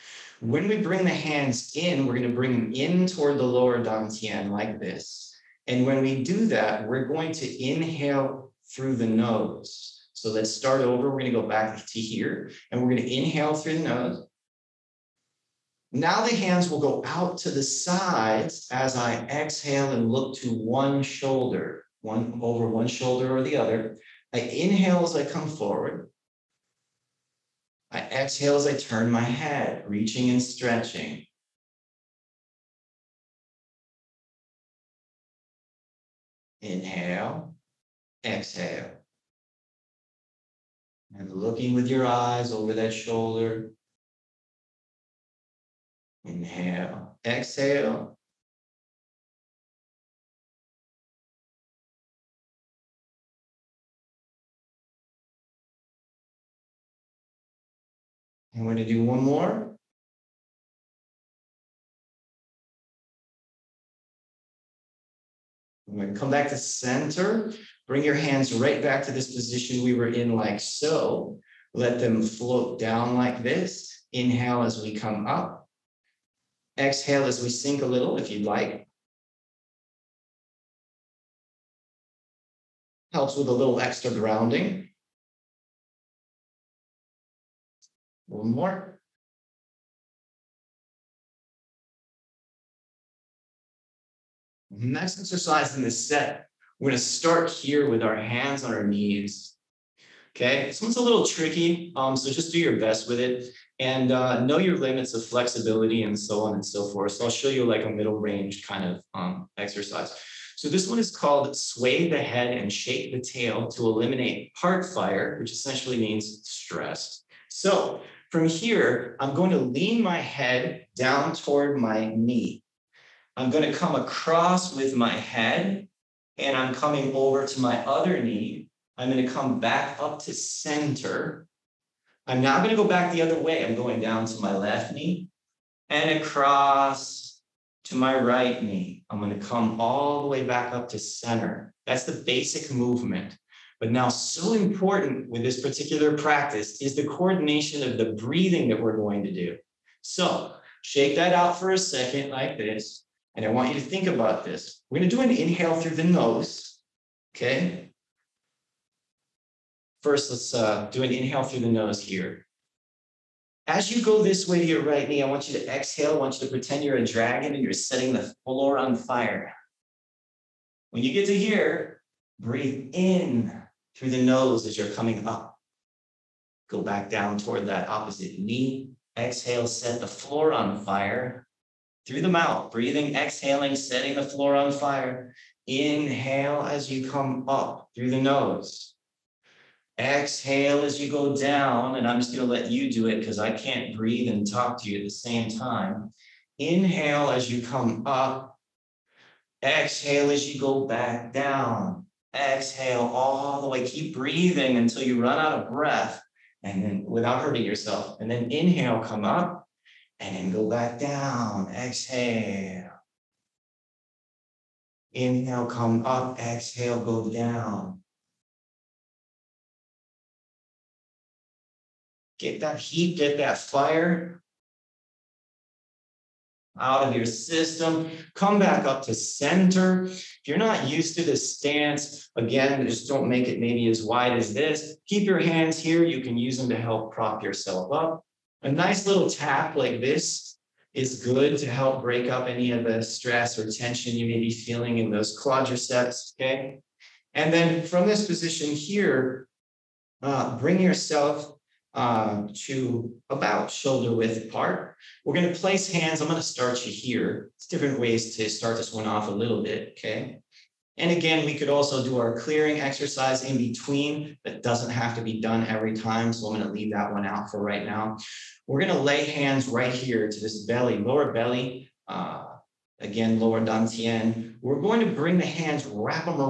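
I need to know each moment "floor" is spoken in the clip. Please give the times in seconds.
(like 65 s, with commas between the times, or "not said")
168 s, 180 s, 184 s.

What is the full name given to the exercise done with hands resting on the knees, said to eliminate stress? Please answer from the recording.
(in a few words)
Sway the head and shake the tail.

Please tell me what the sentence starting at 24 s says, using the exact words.
I inhale as I come forward.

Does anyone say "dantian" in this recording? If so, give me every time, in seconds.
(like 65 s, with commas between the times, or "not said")
3 s, 273 s.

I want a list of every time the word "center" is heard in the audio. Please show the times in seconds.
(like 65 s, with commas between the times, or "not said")
66 s, 130 s, 140 s, 229 s.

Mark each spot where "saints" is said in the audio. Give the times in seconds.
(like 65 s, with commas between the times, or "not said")
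not said.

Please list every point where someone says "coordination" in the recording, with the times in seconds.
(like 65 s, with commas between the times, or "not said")
147 s.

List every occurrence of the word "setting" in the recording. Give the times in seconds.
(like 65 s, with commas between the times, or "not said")
167 s, 183 s.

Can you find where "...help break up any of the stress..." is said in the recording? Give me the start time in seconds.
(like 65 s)
241 s.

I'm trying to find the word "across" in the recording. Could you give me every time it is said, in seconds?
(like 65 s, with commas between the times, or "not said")
123 s, 136 s.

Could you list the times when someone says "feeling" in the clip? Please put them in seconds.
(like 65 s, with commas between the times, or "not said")
244 s.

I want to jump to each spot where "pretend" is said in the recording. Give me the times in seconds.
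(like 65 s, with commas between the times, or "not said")
166 s.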